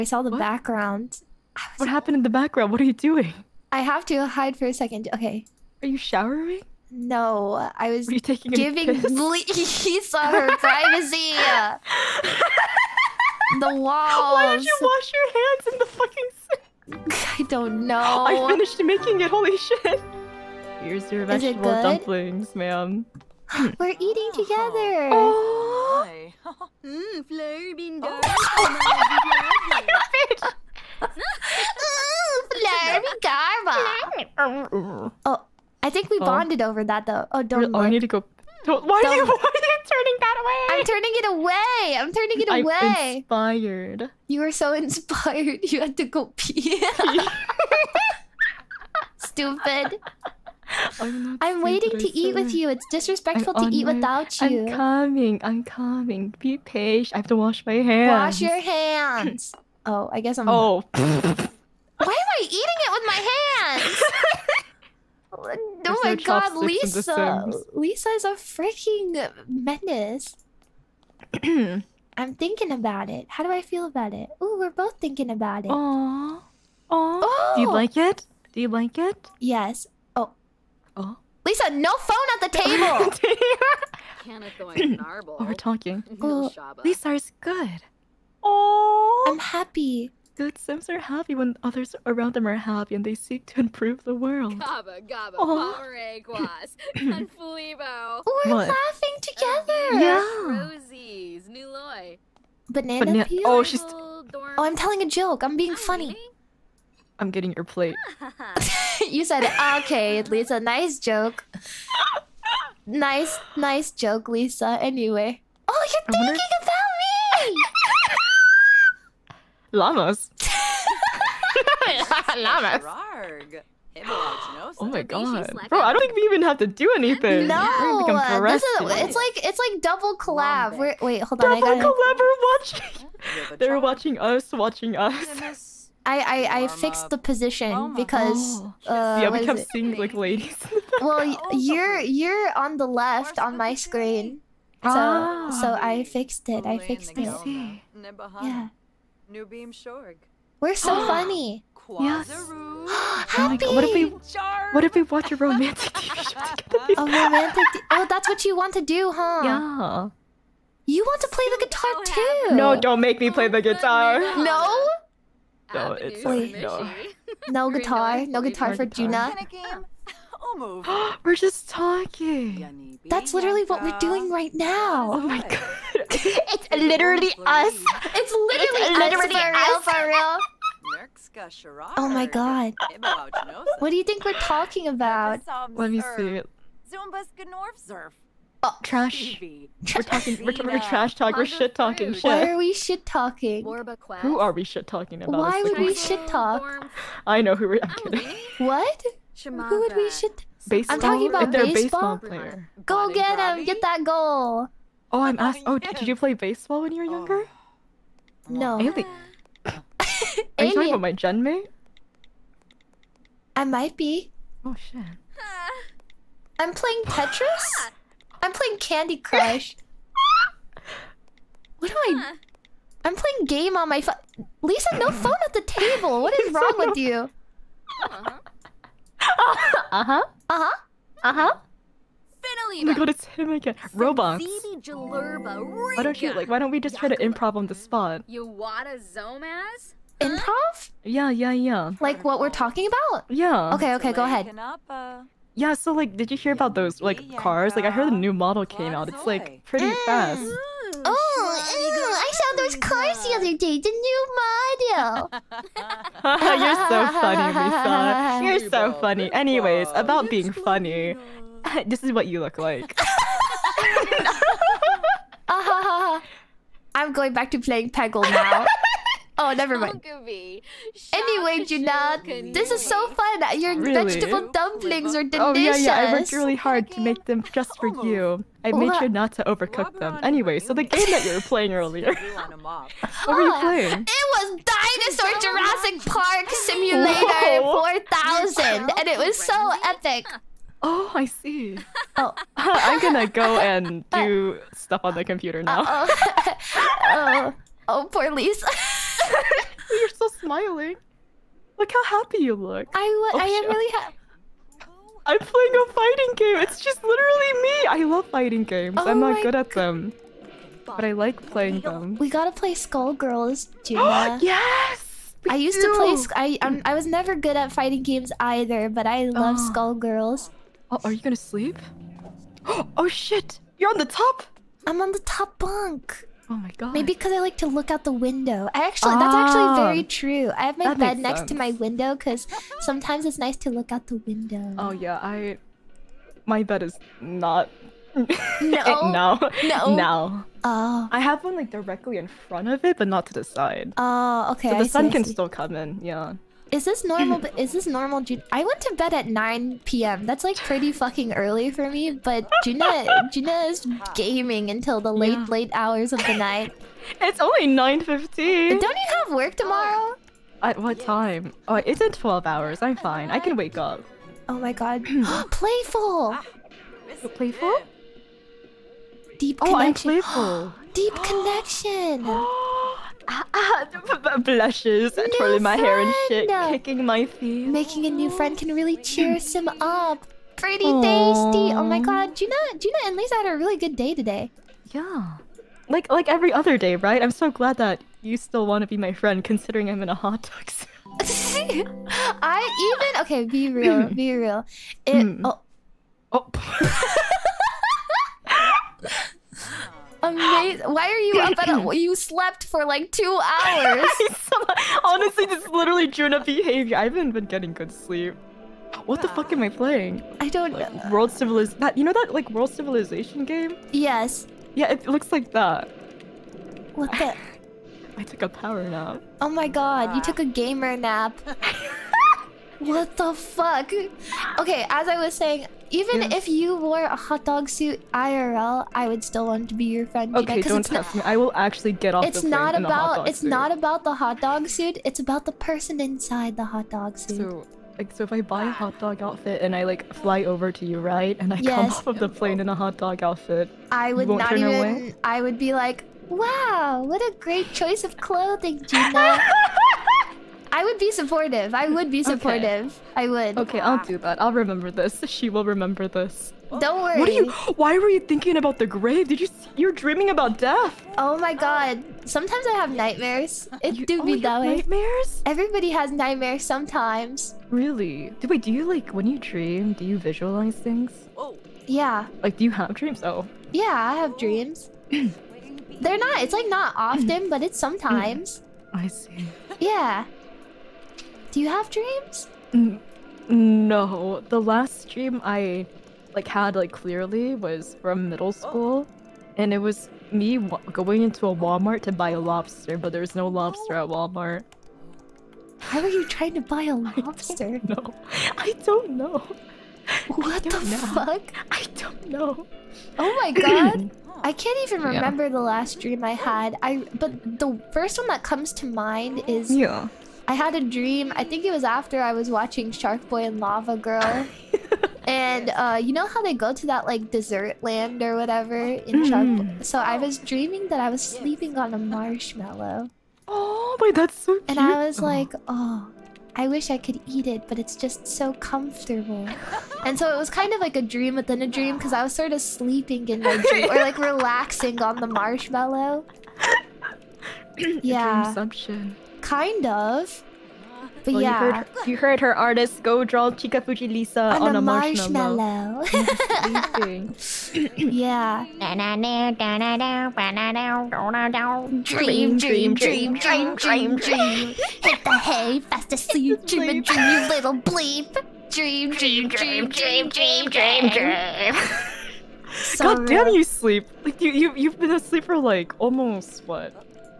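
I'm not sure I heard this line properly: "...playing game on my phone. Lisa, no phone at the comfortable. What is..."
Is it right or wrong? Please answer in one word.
wrong.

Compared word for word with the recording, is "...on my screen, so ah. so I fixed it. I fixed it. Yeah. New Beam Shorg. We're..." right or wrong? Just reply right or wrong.
right.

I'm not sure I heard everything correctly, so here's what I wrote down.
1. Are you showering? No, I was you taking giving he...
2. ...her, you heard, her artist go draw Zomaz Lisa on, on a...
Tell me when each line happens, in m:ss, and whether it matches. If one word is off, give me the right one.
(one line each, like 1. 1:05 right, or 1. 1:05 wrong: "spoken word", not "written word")
1. 0:05 right
2. 9:01 wrong: "Chikafuji", not "Zomaz".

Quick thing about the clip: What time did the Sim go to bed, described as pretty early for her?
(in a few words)
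9 p.m.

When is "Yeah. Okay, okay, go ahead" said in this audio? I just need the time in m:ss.
4:03.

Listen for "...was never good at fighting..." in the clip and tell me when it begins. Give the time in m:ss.
5:16.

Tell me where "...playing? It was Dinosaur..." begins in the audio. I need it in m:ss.
4:43.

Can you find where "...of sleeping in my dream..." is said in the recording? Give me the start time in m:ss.
8:52.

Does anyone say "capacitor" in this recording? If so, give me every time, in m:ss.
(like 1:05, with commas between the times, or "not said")
not said.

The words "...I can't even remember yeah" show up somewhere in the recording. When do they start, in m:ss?
8:24.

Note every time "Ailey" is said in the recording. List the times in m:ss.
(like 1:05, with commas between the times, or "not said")
3:28.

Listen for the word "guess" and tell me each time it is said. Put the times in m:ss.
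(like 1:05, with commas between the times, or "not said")
1:00.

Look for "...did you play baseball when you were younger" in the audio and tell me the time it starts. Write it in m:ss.
3:25.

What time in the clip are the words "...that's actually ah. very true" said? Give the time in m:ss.
5:29.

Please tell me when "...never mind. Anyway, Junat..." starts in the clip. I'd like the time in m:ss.
4:29.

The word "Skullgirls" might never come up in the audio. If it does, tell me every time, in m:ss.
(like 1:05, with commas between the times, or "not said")
5:12, 5:19.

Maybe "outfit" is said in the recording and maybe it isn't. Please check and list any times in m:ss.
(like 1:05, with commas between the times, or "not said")
7:19, 7:23.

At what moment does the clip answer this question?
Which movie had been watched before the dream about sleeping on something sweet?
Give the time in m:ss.
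8:32.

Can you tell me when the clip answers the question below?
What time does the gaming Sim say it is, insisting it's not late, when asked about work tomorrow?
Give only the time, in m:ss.
5:57.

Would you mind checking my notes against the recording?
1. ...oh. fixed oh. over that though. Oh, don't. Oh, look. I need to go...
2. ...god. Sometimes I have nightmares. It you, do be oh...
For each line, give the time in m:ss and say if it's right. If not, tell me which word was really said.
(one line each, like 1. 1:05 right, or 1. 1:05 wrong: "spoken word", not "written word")
1. 0:36 wrong: "bonded", not "fixed"
2. 7:41 right.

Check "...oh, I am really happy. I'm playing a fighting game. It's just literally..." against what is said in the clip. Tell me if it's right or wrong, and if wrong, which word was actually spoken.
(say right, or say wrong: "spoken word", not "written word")
right.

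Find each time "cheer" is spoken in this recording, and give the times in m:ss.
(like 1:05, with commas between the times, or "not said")
6:18.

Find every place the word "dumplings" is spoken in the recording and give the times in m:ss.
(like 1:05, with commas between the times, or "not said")
0:21, 4:34.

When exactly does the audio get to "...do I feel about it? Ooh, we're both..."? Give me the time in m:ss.
1:13.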